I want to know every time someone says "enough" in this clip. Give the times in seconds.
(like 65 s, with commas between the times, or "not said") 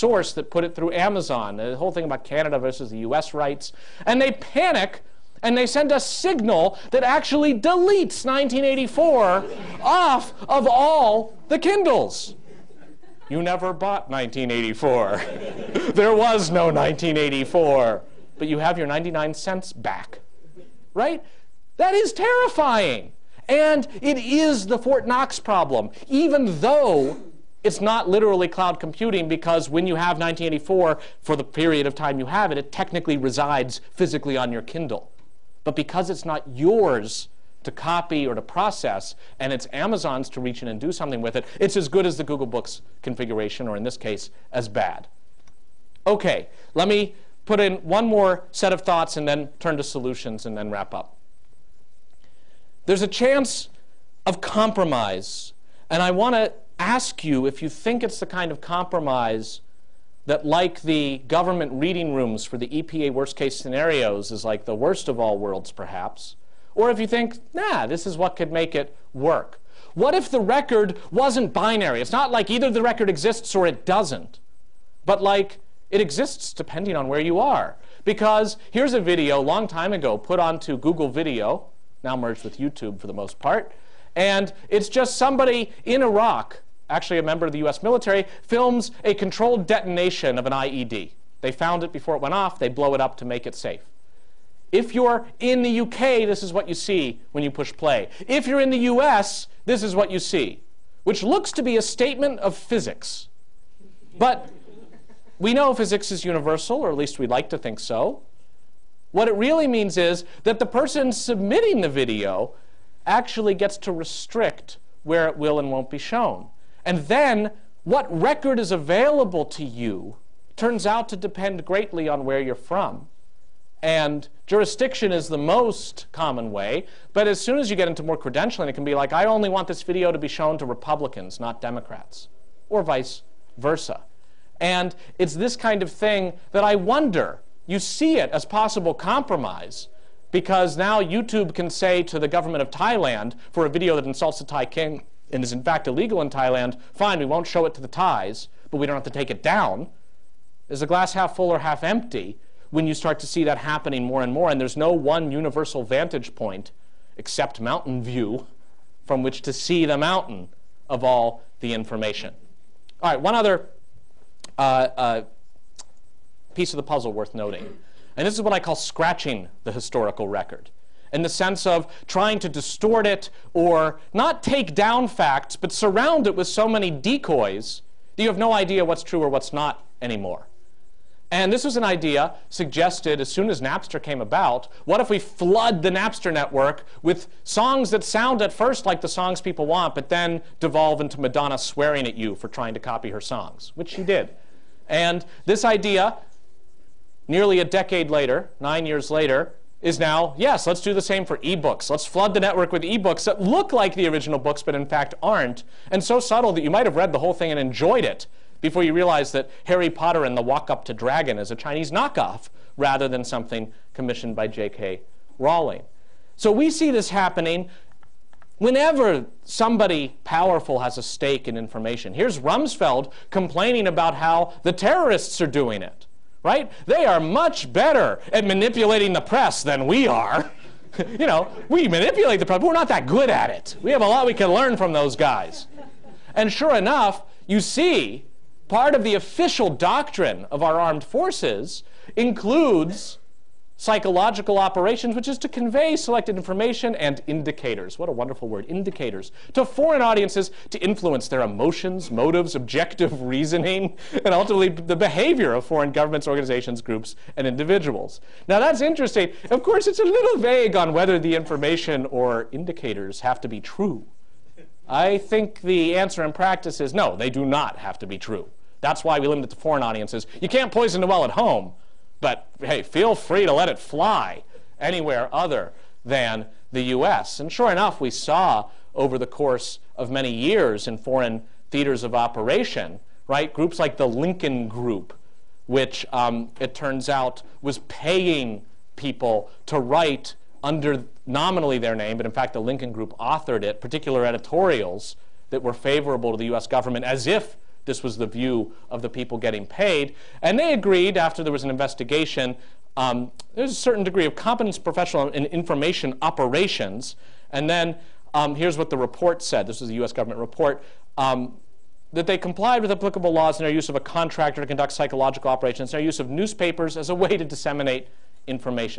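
236 s, 277 s.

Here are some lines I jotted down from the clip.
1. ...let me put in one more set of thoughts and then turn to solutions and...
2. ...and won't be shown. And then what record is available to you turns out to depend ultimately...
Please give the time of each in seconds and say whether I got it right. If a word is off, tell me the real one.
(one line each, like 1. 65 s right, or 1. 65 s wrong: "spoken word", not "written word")
1. 46 s right
2. 115 s wrong: "greatly", not "ultimately".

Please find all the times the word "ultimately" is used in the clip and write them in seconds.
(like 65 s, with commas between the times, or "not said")
254 s.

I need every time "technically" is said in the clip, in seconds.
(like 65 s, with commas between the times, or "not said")
32 s.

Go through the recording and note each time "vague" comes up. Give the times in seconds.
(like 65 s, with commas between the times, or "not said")
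260 s.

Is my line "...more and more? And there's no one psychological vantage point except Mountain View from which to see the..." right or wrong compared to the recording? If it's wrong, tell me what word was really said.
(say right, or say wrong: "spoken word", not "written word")
wrong: "universal", not "psychological".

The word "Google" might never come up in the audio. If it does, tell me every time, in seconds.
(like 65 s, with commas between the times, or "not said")
42 s, 80 s.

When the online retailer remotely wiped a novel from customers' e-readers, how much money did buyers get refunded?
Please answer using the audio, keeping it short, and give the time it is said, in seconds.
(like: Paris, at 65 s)
99 cents, at 18 s.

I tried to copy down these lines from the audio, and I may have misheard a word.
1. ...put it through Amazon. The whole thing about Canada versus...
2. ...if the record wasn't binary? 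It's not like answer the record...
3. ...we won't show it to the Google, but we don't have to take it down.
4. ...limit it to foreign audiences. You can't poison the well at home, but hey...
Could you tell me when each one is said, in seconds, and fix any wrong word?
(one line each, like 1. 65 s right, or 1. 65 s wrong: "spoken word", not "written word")
1. 0 s right
2. 70 s wrong: "either", not "answer"
3. 147 s wrong: "Thais", not "Google"
4. 269 s right.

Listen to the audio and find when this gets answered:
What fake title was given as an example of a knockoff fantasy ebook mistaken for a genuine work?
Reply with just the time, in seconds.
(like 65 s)
209 s.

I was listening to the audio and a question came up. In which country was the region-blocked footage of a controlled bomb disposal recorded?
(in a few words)
Iraq.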